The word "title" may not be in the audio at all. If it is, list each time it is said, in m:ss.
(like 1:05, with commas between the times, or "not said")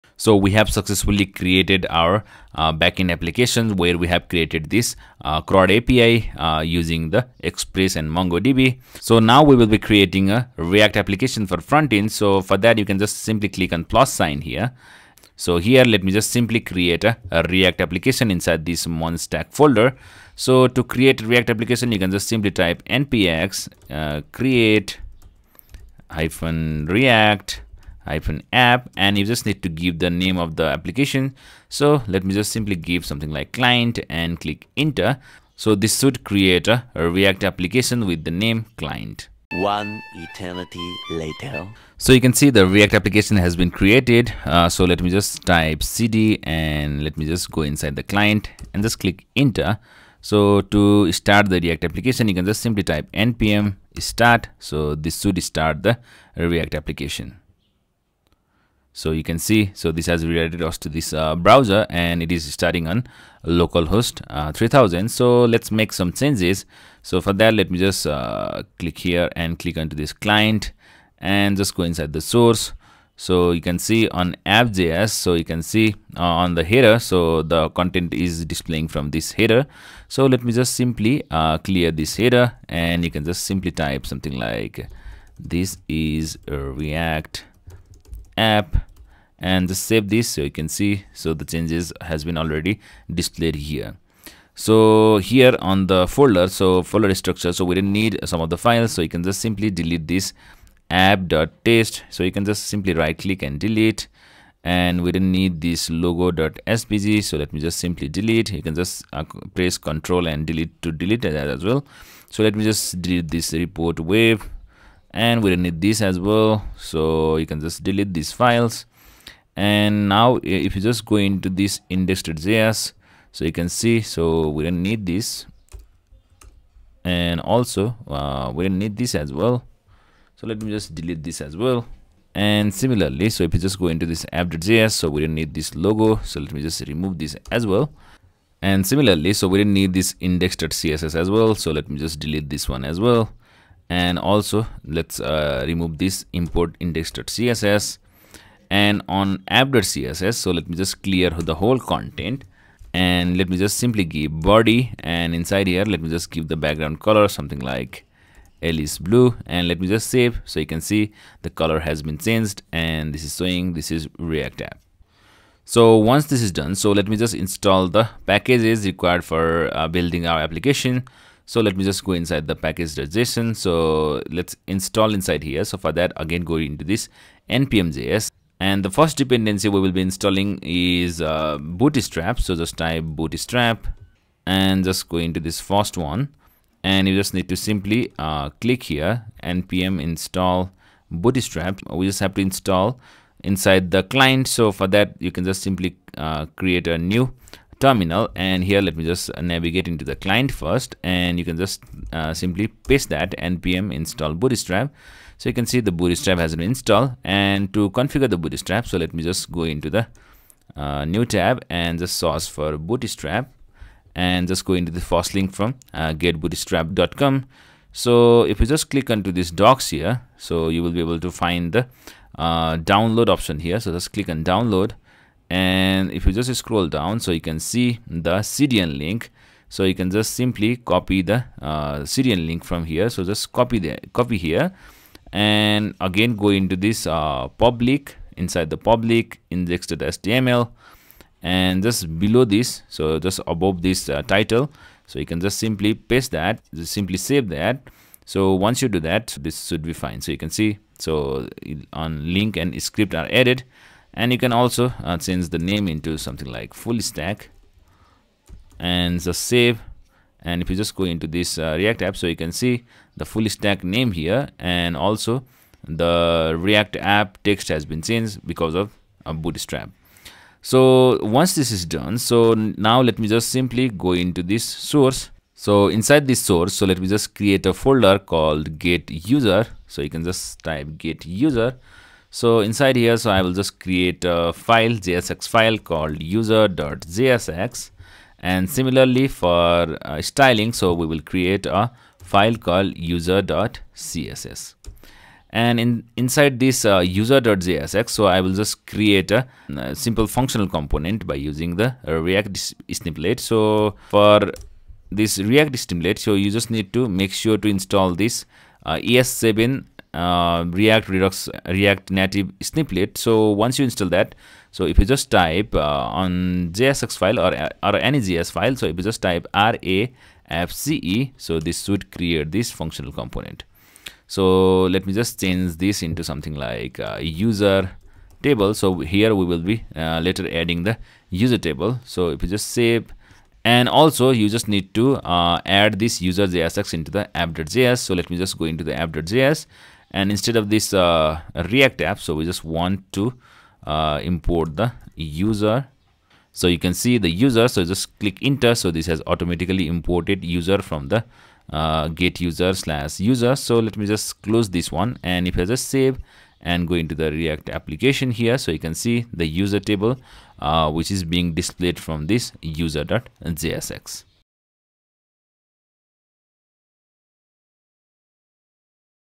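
4:04.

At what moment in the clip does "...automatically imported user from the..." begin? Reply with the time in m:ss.
5:49.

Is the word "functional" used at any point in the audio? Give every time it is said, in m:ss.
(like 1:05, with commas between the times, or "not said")
5:00, 5:22.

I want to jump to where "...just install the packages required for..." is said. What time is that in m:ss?
2:47.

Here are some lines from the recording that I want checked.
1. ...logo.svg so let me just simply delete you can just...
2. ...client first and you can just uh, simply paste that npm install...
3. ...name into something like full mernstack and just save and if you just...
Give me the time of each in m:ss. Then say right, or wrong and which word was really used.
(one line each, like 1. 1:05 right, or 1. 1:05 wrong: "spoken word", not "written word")
1. 1:45 right
2. 3:20 right
3. 4:15 wrong: "stack", not "mernstack".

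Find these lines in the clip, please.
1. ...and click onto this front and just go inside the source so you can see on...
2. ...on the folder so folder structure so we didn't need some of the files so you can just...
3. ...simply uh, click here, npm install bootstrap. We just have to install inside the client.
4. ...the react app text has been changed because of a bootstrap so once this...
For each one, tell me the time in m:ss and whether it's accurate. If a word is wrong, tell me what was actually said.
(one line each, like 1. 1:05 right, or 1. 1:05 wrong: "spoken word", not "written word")
1. 1:09 wrong: "client", not "front"
2. 1:35 right
3. 3:07 right
4. 4:25 right.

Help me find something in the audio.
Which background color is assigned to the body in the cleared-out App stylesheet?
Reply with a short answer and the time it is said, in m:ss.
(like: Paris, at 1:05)
Alice blue, at 2:38.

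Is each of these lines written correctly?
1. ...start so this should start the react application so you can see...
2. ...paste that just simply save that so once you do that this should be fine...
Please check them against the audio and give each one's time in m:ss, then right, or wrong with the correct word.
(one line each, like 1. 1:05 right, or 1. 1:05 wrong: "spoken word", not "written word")
1. 0:53 right
2. 4:05 right.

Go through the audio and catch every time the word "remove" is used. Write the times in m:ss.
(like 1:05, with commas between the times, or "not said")
2:16, 2:25.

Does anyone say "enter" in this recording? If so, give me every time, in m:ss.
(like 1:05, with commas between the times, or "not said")
0:34, 0:49, 5:48.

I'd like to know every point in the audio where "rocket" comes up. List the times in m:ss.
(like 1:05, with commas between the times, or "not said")
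not said.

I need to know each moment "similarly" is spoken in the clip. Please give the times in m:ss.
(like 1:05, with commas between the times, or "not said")
2:12, 2:18, 4:48.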